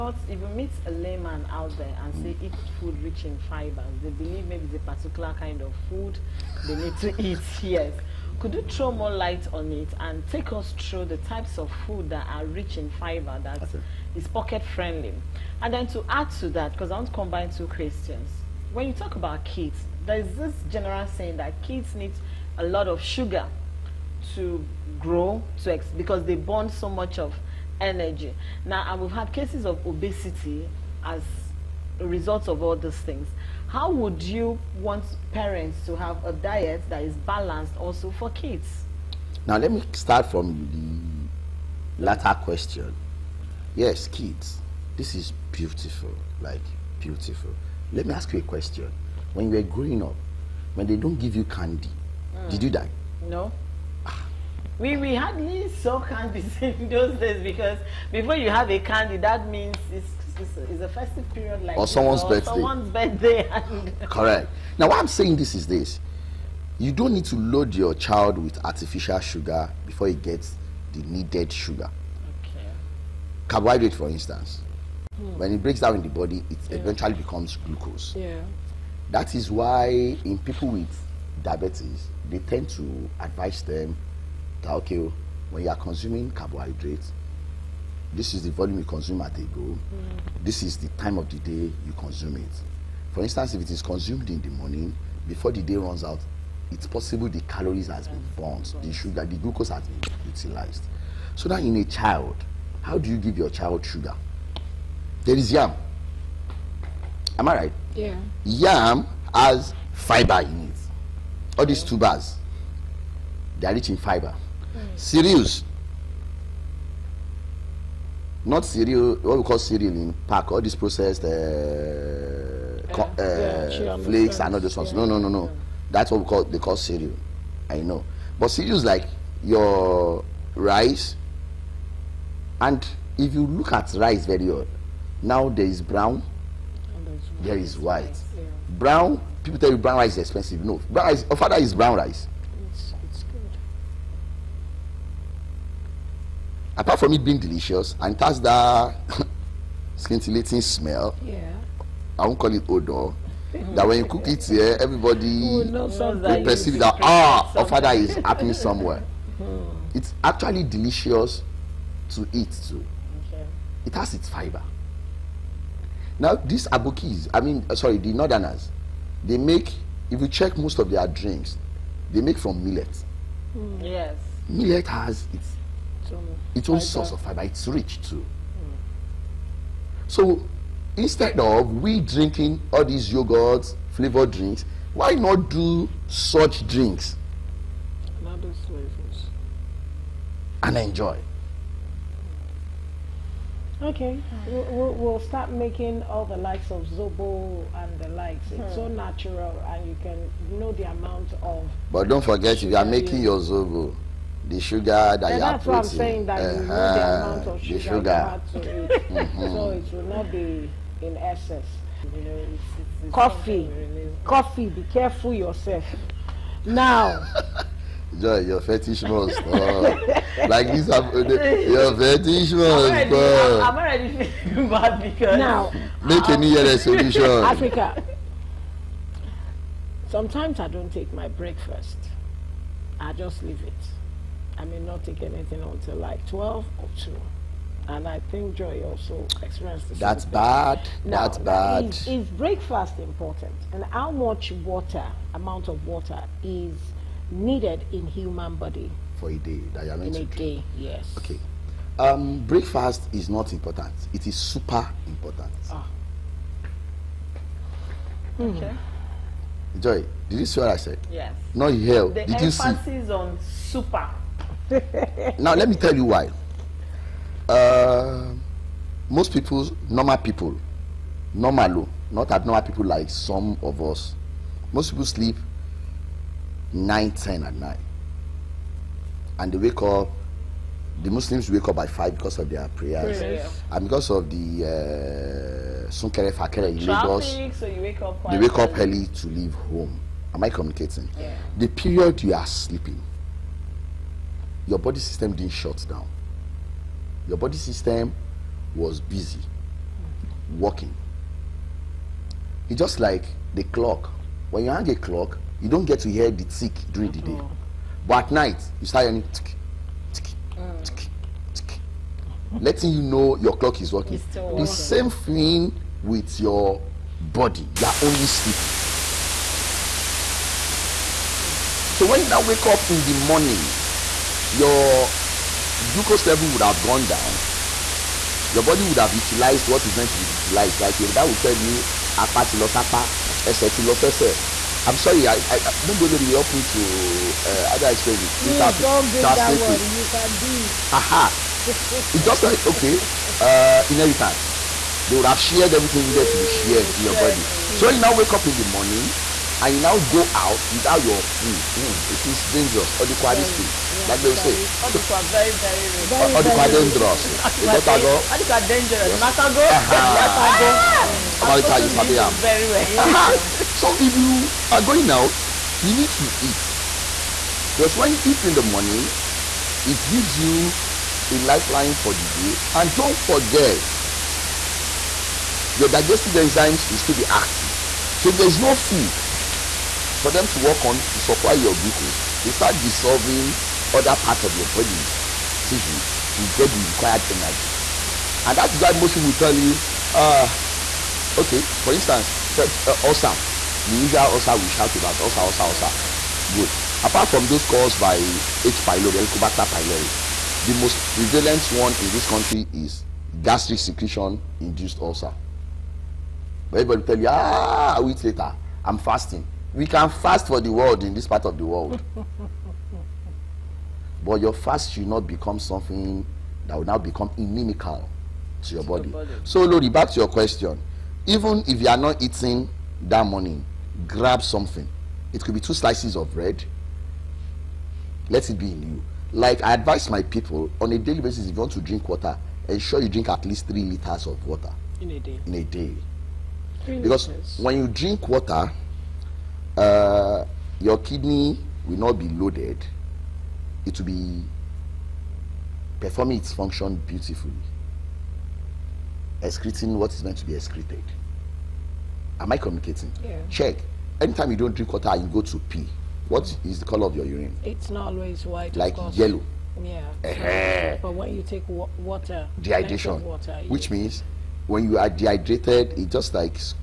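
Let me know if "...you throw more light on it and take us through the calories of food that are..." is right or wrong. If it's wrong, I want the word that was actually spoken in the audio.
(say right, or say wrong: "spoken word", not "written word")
wrong: "types", not "calories".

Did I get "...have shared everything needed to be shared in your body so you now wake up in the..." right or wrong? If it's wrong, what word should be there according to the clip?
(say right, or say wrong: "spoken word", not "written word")
right.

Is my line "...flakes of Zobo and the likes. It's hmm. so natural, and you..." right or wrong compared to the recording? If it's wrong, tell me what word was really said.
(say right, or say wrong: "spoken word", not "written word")
wrong: "likes", not "flakes".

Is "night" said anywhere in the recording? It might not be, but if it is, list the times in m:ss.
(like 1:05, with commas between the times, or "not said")
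4:37, 5:08.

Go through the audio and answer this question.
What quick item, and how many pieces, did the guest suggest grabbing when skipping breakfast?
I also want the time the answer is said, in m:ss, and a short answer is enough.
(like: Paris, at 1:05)
2 slices of bread, at 7:05.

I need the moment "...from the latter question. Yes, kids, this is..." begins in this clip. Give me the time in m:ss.
0:40.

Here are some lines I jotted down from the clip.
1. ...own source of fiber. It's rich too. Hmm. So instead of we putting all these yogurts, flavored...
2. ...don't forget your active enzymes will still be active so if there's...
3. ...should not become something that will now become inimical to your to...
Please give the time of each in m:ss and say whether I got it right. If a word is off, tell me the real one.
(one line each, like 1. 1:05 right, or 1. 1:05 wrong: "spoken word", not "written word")
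1. 2:56 wrong: "drinking", not "putting"
2. 6:12 wrong: "digestive", not "active"
3. 6:54 right.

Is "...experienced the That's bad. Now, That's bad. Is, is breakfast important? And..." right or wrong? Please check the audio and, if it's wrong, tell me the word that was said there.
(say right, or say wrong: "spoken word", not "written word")
right.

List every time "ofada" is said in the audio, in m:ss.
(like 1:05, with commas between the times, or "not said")
2:21, 2:37.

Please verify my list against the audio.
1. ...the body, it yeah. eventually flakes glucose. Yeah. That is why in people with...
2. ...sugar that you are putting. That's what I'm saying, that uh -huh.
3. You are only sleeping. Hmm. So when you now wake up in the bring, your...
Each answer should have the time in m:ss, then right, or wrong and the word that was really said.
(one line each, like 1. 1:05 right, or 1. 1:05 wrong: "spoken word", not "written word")
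1. 1:16 wrong: "becomes", not "flakes"
2. 3:24 right
3. 5:17 wrong: "morning", not "bring".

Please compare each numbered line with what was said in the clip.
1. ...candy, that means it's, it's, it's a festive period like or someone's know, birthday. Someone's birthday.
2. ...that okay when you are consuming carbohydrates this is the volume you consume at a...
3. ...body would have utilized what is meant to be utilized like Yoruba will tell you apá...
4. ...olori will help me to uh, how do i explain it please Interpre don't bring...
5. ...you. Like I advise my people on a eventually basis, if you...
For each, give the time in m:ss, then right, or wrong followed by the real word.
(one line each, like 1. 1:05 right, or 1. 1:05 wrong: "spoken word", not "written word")
1. 0:58 right
2. 1:24 right
3. 5:28 right
4. 5:36 right
5. 7:08 wrong: "daily", not "eventually".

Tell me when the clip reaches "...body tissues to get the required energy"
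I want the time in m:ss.
6:24.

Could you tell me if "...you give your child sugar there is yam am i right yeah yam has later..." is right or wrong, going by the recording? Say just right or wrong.
wrong.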